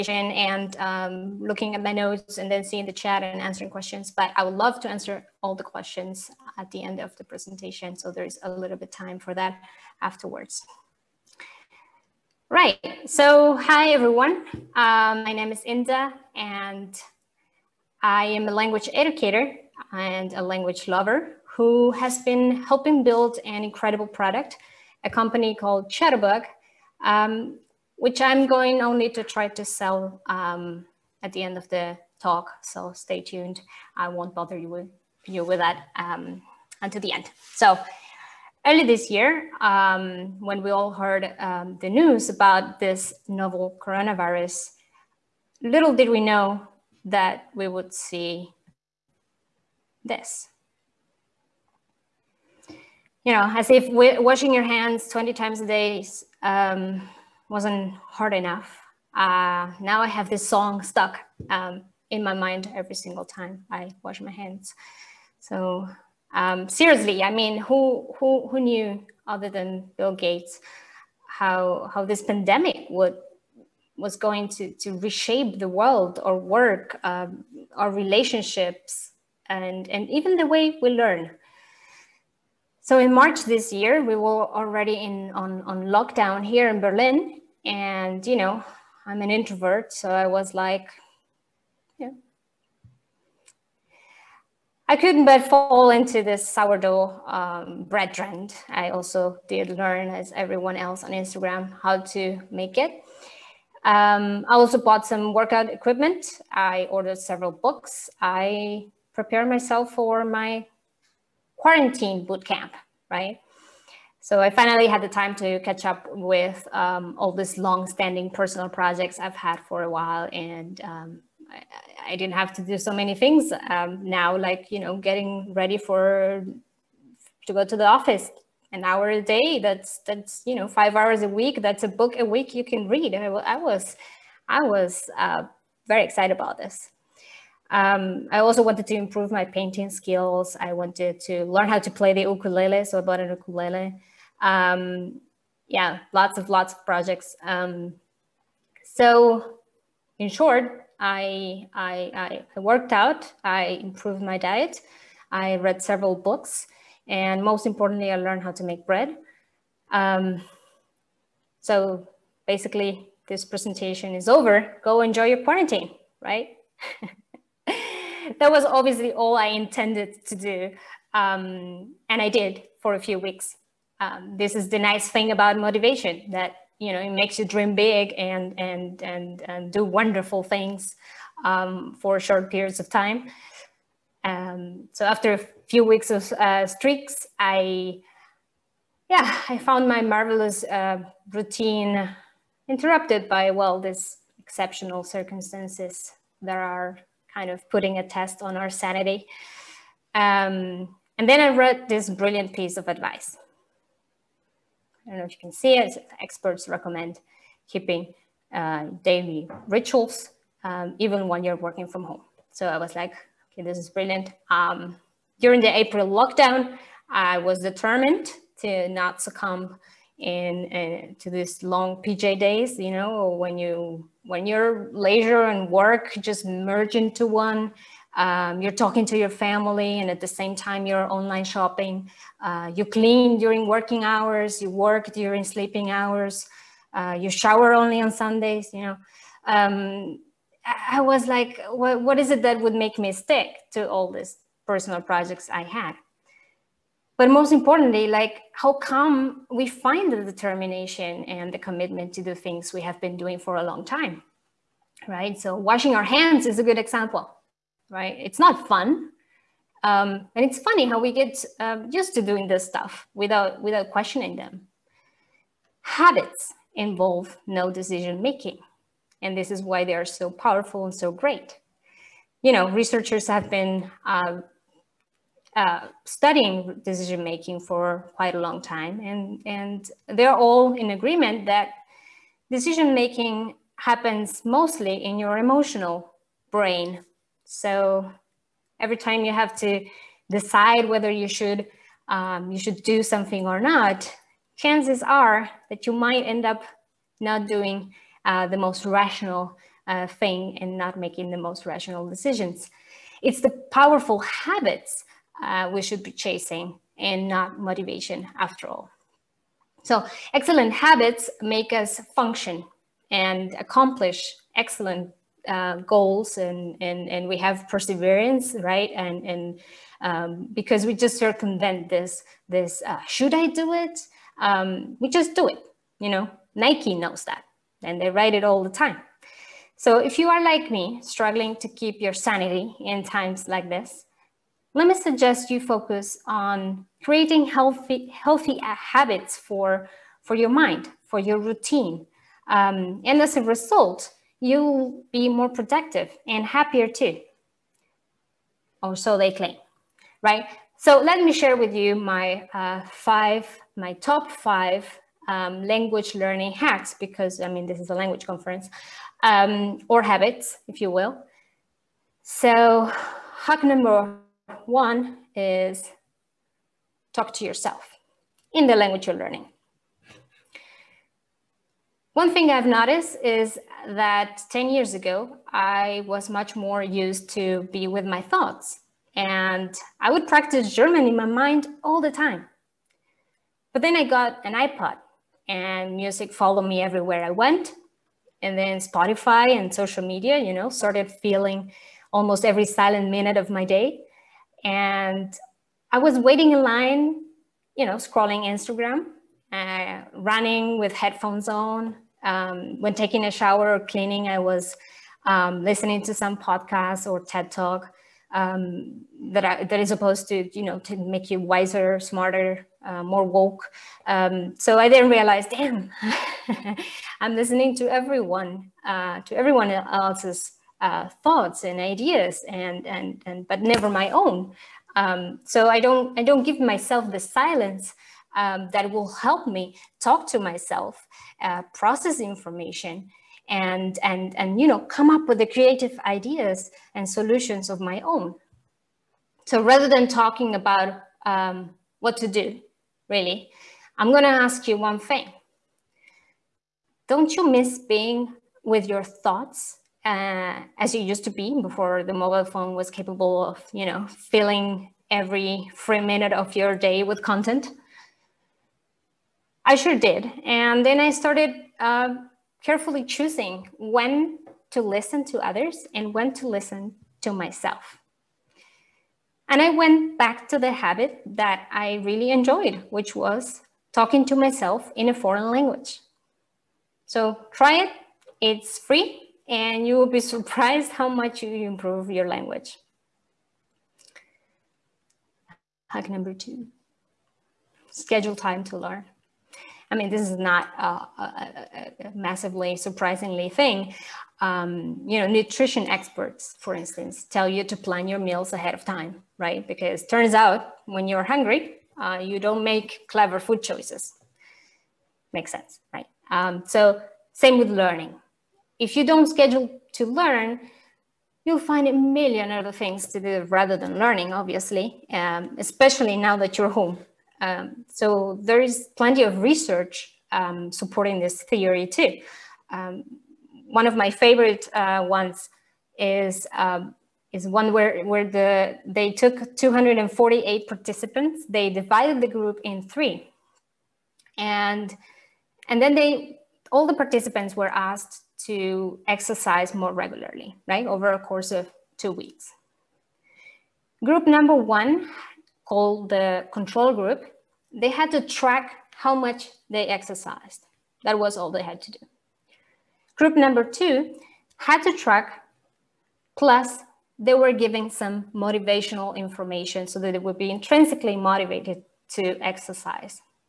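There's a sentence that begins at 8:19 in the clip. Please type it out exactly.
Because turns out when you're hungry, uh, you don't make clever food choices.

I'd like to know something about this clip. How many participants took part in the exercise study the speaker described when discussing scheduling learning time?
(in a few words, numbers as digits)
248.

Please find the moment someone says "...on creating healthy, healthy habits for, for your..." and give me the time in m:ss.
5:36.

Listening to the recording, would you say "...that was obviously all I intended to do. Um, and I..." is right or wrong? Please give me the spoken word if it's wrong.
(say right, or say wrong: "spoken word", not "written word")
right.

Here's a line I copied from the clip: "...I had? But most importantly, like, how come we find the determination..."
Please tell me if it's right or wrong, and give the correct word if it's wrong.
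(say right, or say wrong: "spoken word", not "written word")
right.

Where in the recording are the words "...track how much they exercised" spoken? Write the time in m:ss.
9:08.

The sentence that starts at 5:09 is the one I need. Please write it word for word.
So excellent habits make us function and accomplish excellent uh, goals and, and, and we have perseverance, right?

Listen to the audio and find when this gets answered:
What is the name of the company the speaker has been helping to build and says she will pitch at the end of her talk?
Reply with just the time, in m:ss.
0:25.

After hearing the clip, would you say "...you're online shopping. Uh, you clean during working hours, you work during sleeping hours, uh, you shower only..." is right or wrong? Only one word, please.
right.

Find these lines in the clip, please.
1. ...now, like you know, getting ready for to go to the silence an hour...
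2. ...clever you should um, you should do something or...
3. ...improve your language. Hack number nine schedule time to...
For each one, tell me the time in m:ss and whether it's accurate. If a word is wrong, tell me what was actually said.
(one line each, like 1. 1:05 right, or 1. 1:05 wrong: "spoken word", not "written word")
1. 2:04 wrong: "office", not "silence"
2. 4:50 wrong: "whether", not "clever"
3. 8:01 wrong: "two", not "nine".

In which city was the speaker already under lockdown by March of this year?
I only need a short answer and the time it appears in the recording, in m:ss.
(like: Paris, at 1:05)
Berlin, at 1:26.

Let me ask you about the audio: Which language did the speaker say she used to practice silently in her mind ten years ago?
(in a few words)
German.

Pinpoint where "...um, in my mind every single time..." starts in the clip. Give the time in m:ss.
1:01.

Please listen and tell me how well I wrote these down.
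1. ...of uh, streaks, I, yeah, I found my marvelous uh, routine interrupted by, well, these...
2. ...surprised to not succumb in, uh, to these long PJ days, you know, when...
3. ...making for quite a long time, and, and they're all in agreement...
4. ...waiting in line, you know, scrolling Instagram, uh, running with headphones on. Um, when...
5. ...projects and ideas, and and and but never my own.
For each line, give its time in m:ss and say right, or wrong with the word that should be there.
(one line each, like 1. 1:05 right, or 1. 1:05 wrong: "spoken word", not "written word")
1. 3:06 right
2. 3:37 wrong: "determined", not "surprised"
3. 4:37 right
4. 6:36 right
5. 7:01 wrong: "thoughts", not "projects".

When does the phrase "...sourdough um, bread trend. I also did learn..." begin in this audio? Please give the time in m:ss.
1:36.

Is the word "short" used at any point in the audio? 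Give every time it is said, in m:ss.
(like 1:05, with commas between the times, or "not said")
2:30, 3:02.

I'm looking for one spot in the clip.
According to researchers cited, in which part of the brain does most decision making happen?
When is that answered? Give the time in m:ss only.
4:45.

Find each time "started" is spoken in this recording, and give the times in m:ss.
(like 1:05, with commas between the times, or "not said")
6:30, 7:41.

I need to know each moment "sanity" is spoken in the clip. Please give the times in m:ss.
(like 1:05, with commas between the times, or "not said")
3:18, 5:32.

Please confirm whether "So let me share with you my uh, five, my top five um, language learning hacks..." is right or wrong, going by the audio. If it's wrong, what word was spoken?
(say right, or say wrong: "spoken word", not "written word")
right.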